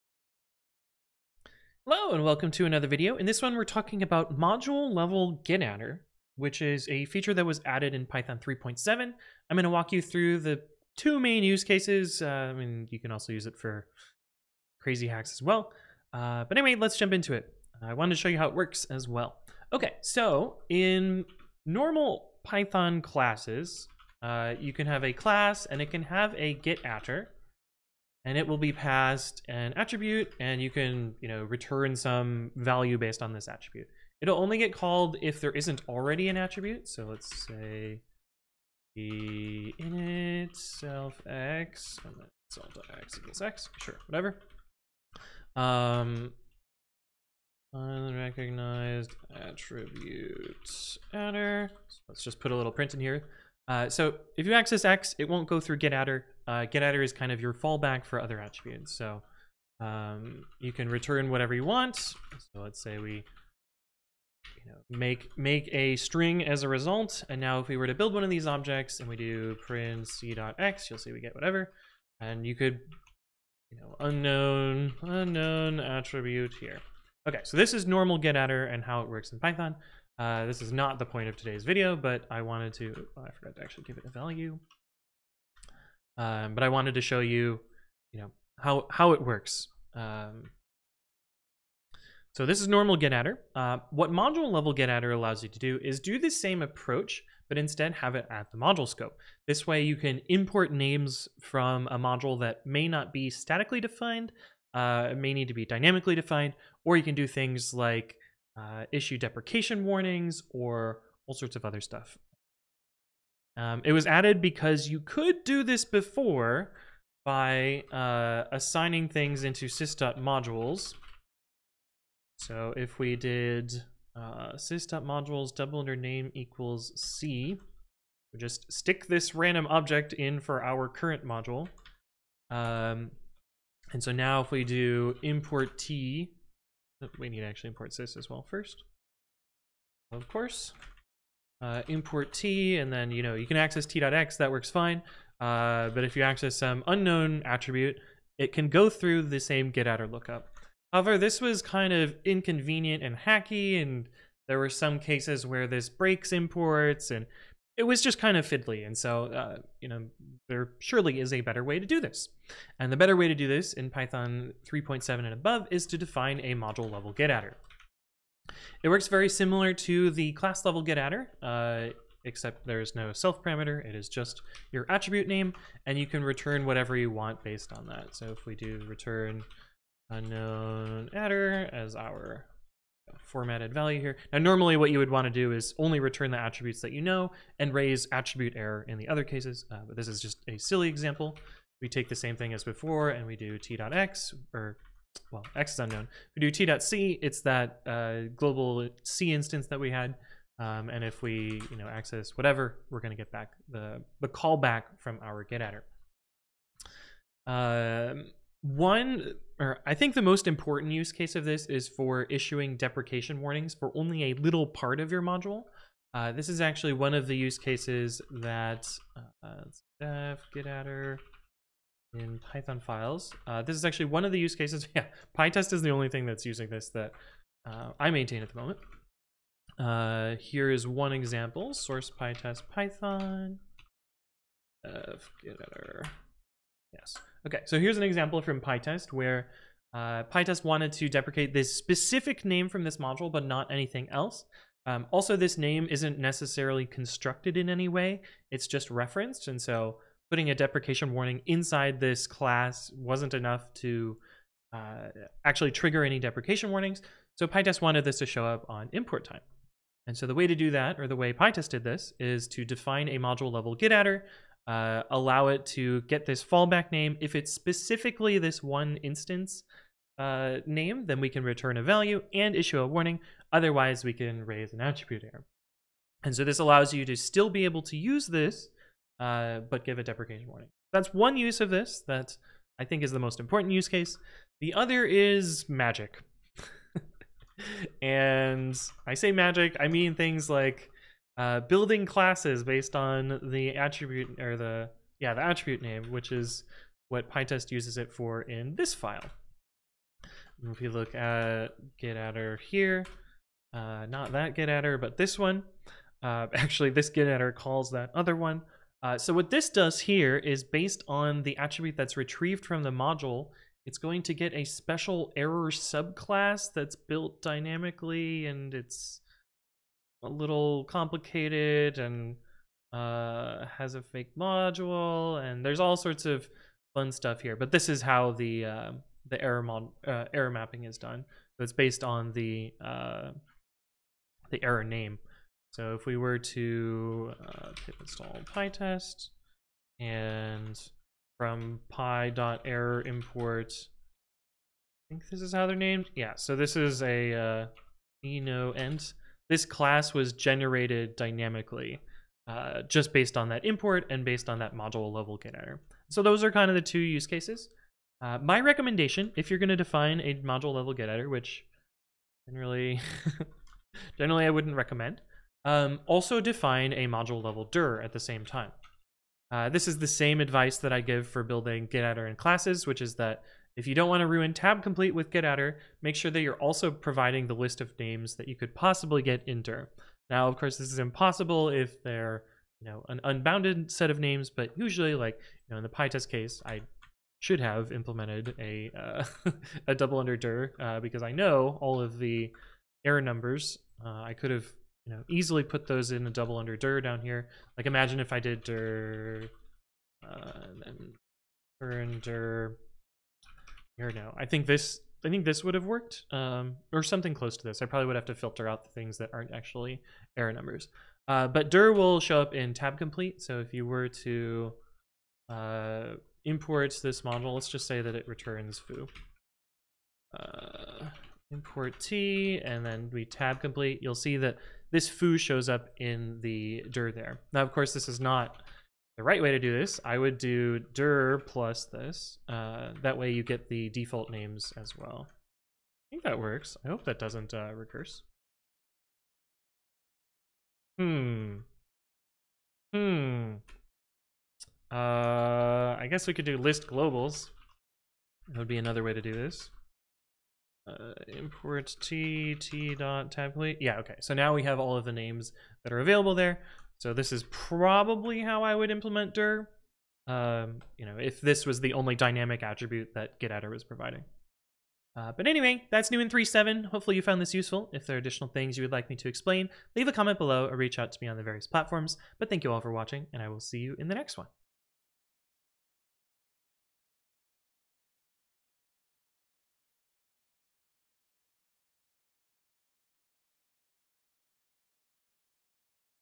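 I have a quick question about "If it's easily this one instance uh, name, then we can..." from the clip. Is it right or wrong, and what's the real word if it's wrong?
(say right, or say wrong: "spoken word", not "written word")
wrong: "specifically", not "easily".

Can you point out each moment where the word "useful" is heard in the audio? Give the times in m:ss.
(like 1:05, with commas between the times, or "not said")
7:47.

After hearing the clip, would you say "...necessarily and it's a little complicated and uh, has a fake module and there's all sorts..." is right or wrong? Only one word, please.
wrong.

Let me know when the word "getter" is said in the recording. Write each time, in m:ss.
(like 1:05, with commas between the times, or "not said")
2:47, 5:55.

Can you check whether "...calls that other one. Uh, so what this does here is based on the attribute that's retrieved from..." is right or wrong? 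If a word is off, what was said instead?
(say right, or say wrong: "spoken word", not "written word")
right.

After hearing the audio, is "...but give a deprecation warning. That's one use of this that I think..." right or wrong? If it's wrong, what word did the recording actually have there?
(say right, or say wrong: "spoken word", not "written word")
right.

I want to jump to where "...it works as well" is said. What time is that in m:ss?
0:18.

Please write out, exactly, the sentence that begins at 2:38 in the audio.
And so, uh, you know, there surely is a better way to do this.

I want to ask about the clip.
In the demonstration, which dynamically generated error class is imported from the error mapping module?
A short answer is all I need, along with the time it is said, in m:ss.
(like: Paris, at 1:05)
ENOENT, at 5:48.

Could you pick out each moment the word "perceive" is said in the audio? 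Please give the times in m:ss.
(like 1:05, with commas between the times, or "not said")
not said.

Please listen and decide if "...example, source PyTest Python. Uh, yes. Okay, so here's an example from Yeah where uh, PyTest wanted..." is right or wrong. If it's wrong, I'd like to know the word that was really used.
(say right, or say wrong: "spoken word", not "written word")
wrong: "PyTest", not "Yeah".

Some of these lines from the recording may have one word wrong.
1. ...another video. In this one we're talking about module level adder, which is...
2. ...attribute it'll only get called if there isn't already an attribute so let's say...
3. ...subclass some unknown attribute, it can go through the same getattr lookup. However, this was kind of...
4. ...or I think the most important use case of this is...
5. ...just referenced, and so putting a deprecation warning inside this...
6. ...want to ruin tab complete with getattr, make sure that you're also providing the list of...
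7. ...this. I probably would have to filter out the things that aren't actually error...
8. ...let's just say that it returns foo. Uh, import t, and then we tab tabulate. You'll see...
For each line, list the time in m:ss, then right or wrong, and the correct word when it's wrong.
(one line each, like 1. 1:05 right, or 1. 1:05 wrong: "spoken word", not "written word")
1. 0:02 right
2. 0:33 right
3. 2:26 wrong: "access", not "subclass"
4. 3:29 right
5. 4:08 right
6. 6:14 right
7. 6:47 right
8. 6:57 wrong: "complete", not "tabulate".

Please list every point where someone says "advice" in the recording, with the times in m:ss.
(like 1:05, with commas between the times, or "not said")
6:10.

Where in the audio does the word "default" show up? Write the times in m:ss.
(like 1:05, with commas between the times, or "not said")
7:13.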